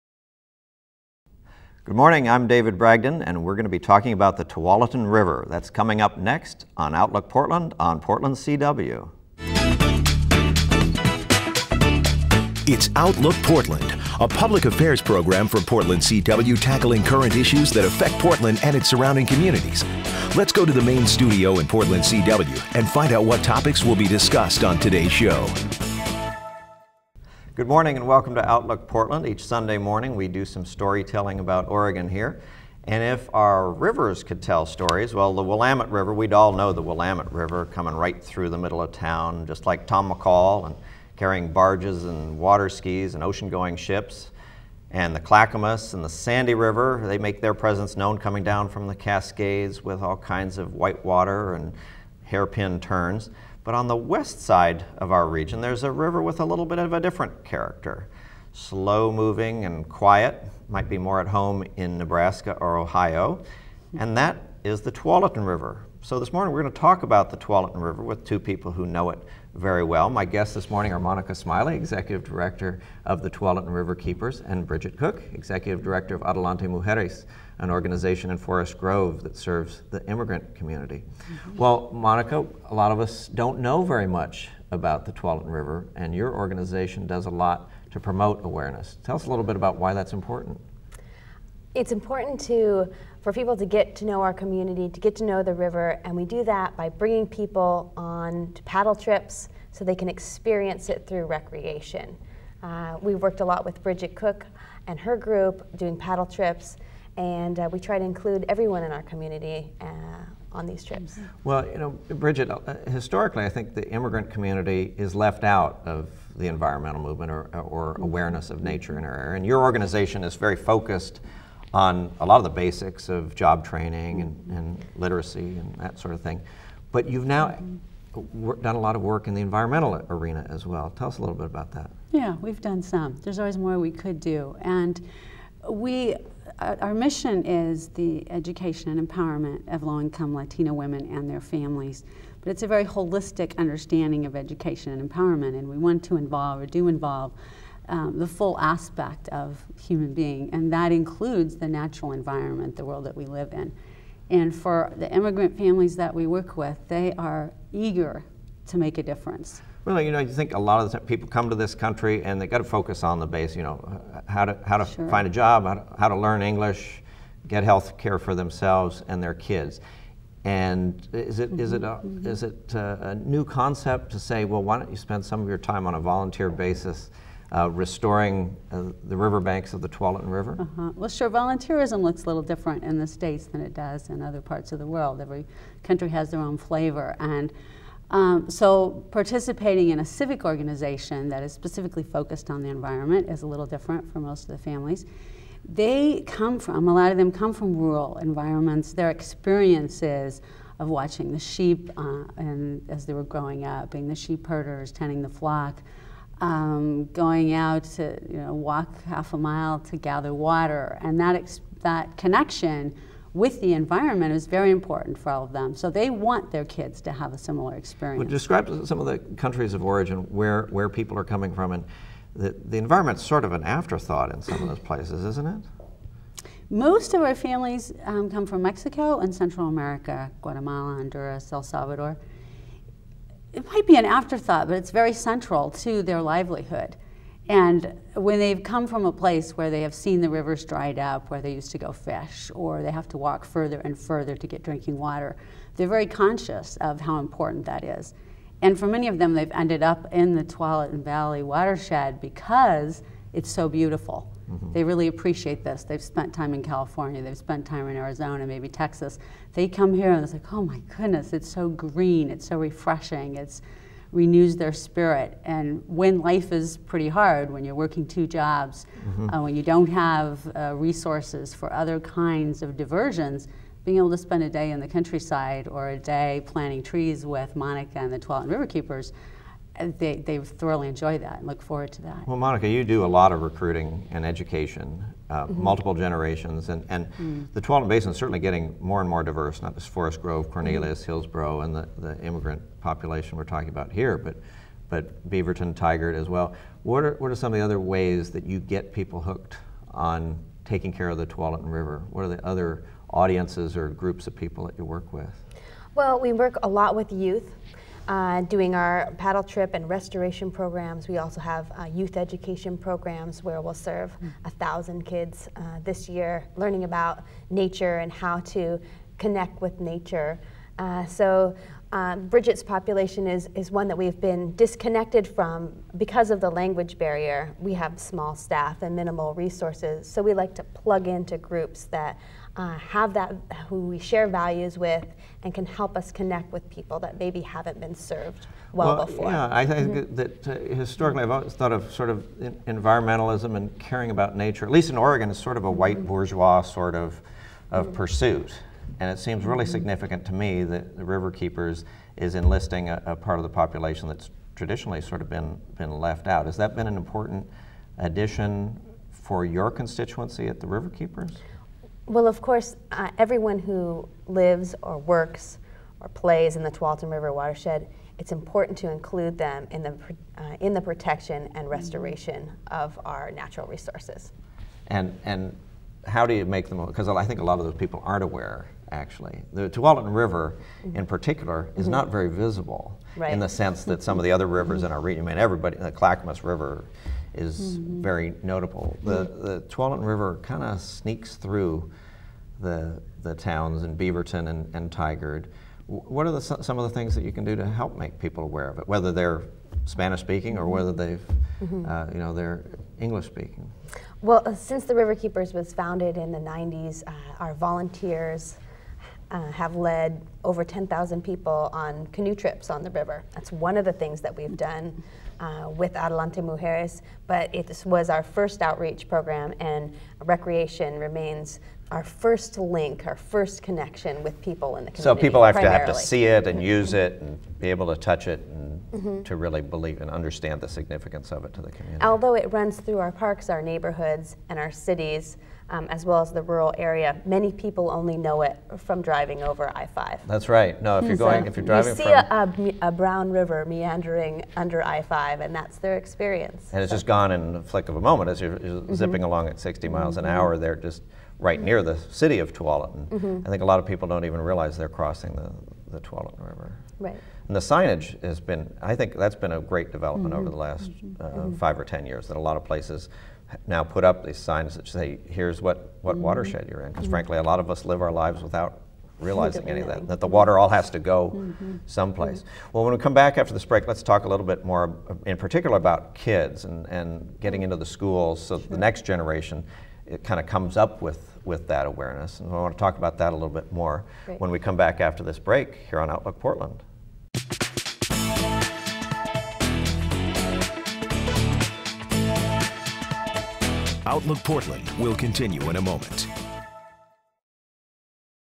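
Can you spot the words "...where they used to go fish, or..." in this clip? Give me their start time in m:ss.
4:01.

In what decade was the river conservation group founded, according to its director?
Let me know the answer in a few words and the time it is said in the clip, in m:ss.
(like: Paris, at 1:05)
the 90s, at 6:46.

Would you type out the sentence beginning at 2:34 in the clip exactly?
And for the immigrant families that we work with, they are eager to make a difference.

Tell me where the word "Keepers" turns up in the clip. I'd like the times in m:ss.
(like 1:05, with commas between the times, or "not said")
1:13, 4:38, 5:51, 6:00, 6:45.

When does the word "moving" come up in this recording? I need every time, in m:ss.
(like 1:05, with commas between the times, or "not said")
0:59.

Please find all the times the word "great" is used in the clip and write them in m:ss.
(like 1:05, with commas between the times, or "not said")
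7:39, 8:04.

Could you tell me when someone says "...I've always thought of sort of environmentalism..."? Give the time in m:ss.
5:41.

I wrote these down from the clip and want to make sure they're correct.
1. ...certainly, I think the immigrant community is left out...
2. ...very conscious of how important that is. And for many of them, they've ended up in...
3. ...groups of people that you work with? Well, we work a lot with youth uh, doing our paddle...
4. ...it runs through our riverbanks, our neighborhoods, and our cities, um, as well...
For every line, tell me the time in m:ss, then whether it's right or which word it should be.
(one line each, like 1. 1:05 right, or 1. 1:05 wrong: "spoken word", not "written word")
1. 1:52 wrong: "historically", not "certainly"
2. 4:05 right
3. 5:03 right
4. 7:12 wrong: "parks", not "riverbanks".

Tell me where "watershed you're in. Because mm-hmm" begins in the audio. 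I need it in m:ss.
7:46.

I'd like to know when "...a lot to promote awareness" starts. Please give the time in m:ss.
1:27.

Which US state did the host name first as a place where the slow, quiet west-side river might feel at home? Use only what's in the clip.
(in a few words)
Nebraska.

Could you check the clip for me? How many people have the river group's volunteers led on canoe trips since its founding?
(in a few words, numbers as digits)
over 10,000.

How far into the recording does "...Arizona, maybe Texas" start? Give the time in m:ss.
4:17.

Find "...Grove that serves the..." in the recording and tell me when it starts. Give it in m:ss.
1:18.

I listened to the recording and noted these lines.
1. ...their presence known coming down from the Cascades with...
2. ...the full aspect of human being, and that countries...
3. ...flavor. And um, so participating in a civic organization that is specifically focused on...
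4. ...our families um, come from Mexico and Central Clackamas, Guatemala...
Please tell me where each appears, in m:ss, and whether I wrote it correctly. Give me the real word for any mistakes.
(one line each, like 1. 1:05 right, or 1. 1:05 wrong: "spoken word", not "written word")
1. 0:47 right
2. 2:28 wrong: "includes", not "countries"
3. 3:06 right
4. 3:47 wrong: "America", not "Clackamas".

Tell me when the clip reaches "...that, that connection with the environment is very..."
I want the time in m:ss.
3:31.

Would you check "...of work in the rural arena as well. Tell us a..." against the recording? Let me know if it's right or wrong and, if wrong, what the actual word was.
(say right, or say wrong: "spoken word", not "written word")
wrong: "environmental", not "rural".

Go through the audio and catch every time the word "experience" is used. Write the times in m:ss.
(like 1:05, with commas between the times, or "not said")
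1:40, 3:19, 3:37, 7:25.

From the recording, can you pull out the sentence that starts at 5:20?
Uh, so um, Bridget's population is, is one that we've been disconnected from because of the language barrier.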